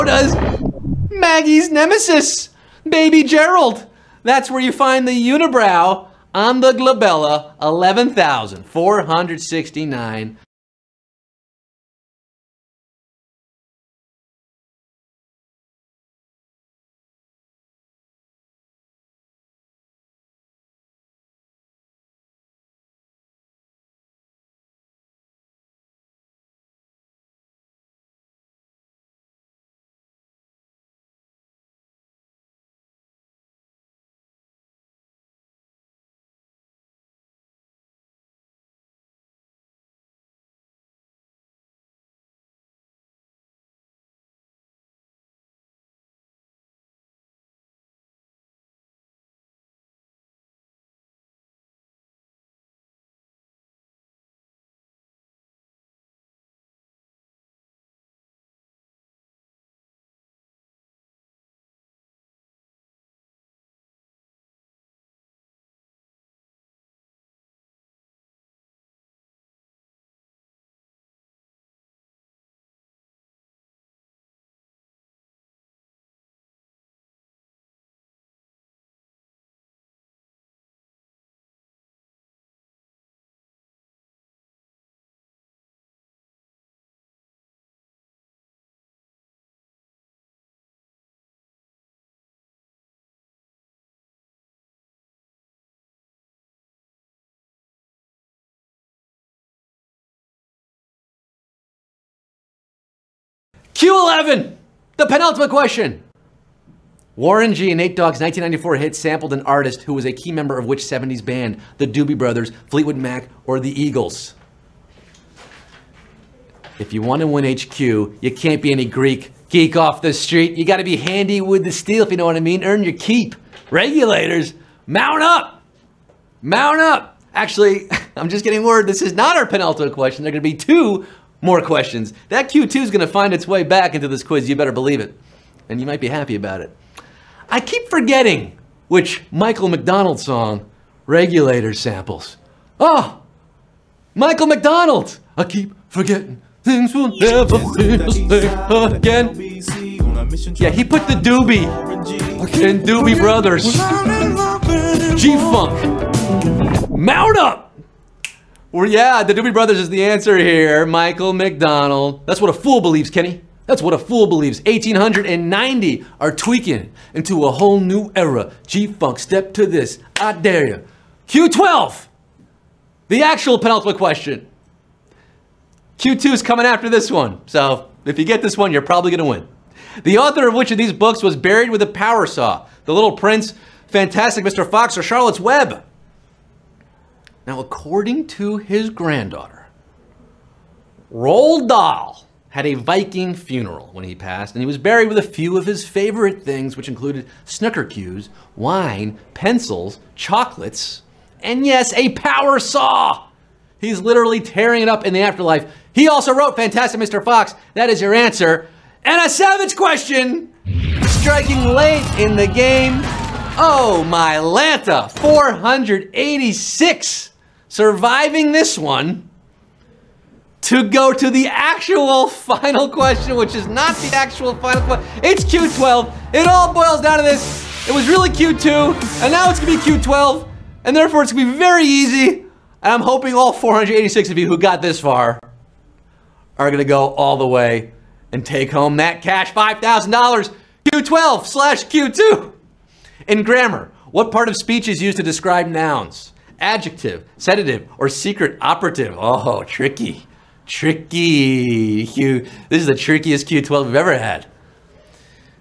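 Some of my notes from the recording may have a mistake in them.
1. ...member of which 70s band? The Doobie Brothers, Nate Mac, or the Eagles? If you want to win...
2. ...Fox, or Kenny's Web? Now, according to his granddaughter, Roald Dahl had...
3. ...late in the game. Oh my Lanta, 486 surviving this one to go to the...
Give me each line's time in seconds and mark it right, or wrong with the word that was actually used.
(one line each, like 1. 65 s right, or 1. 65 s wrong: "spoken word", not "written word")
1. 110 s wrong: "Fleetwood", not "Nate"
2. 184 s wrong: "Charlotte", not "Kenny"
3. 211 s right.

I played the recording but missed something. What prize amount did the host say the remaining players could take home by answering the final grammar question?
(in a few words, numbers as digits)
$5,000.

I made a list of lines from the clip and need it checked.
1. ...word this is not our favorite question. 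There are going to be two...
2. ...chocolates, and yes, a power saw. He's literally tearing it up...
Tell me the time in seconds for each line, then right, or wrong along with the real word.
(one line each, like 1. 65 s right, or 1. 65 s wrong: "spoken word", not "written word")
1. 128 s wrong: "penultimate", not "favorite"
2. 200 s right.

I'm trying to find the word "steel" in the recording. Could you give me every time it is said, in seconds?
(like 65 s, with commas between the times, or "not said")
121 s.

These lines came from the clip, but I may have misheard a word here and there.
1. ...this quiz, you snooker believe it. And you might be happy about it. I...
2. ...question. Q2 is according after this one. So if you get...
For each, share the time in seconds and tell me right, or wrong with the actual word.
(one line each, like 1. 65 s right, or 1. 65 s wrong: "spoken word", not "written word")
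1. 134 s wrong: "better", not "snooker"
2. 173 s wrong: "coming", not "according".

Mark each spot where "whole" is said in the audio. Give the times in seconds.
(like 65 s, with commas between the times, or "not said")
167 s.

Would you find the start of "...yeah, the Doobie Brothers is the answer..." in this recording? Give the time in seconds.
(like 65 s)
158 s.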